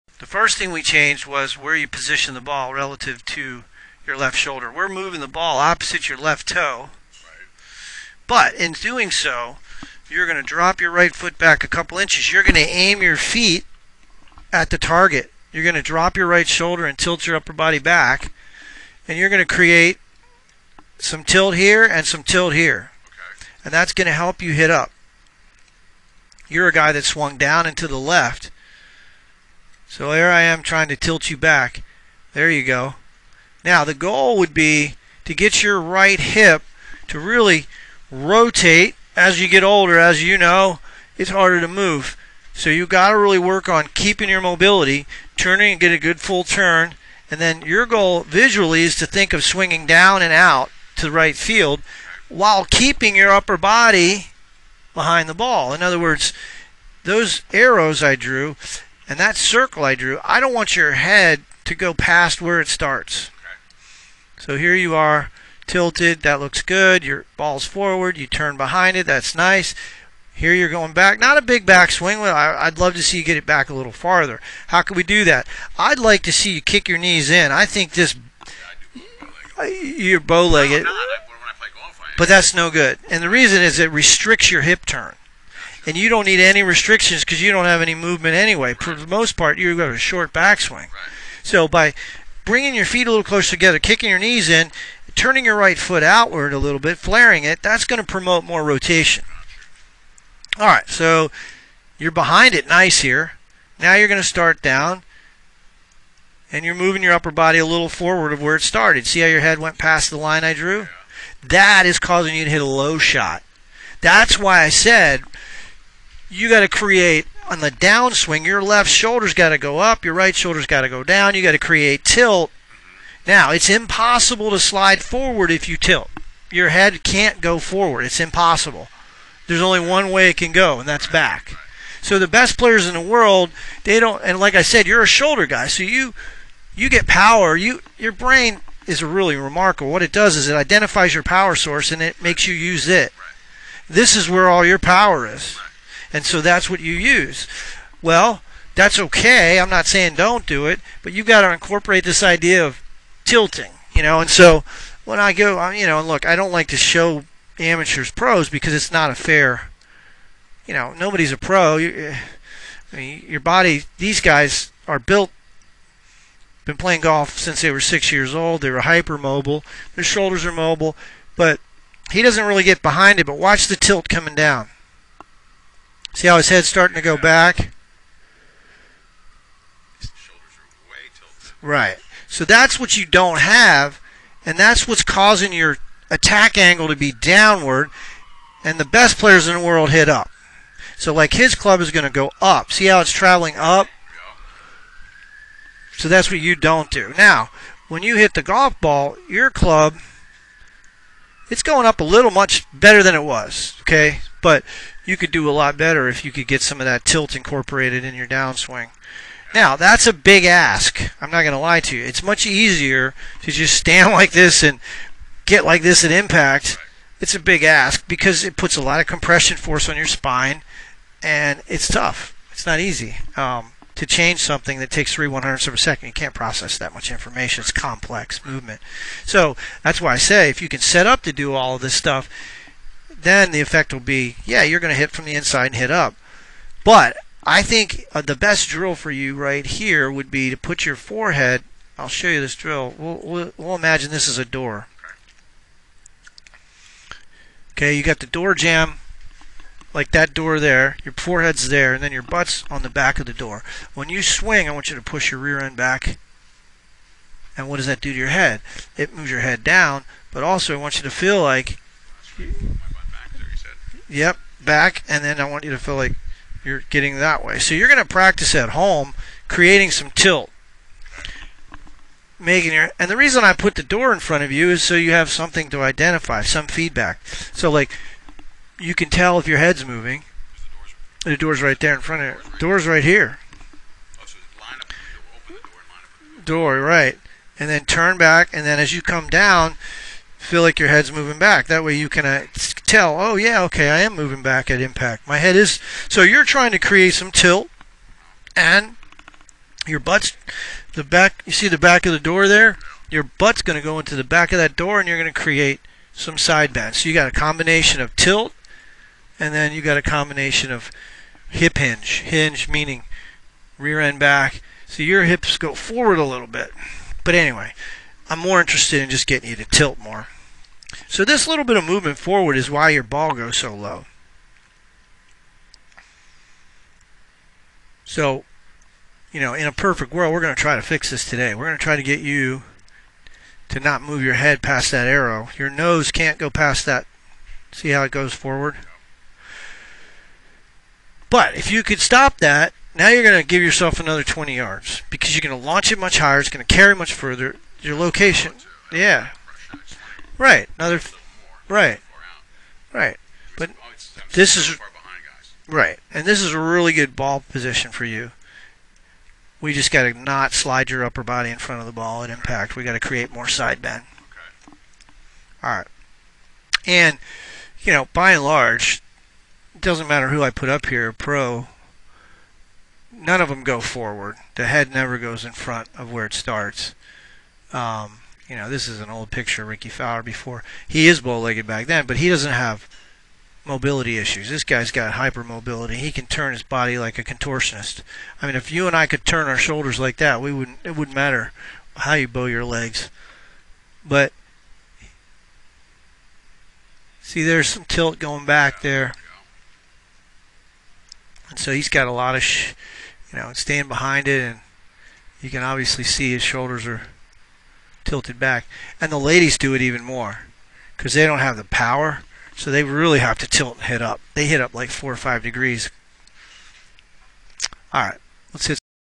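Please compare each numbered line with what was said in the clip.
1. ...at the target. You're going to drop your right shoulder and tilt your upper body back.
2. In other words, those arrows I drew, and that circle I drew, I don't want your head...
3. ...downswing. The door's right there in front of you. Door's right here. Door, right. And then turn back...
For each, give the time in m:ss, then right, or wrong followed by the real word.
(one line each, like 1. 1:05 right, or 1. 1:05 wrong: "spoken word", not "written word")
1. 0:14 right
2. 0:55 right
3. 4:39 wrong: "moving", not "downswing".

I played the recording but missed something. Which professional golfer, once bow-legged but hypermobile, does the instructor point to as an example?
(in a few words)
Rickie Fowler.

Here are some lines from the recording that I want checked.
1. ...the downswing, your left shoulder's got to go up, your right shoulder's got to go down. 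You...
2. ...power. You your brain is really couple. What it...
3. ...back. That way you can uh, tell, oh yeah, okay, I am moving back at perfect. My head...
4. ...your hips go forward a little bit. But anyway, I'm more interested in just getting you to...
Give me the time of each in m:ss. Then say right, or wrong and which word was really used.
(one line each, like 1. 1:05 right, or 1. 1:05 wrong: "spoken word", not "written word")
1. 1:57 right
2. 2:17 wrong: "remarkable", not "couple"
3. 4:51 wrong: "impact", not "perfect"
4. 5:15 right.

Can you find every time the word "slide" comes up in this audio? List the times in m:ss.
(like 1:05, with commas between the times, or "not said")
2:04, 6:00.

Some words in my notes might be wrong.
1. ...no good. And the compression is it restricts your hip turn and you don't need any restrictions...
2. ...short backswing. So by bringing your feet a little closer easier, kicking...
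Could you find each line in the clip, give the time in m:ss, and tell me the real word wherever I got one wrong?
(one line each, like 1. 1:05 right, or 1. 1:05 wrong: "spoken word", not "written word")
1. 1:22 wrong: "reason", not "compression"
2. 1:29 wrong: "together", not "easier".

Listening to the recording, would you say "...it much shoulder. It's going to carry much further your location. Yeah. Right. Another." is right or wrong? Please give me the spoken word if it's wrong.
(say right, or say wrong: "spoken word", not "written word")
wrong: "higher", not "shoulder".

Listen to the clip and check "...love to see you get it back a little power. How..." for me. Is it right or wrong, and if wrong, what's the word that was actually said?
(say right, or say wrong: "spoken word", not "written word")
wrong: "farther", not "power".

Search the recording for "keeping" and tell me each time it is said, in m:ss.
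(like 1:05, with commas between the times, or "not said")
0:43, 0:52.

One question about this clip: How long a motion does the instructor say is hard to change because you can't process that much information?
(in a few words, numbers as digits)
Three one hundredths of a second.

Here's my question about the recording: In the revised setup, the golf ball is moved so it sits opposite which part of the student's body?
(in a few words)
Left toe.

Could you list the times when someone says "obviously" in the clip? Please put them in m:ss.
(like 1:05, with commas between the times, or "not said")
6:45.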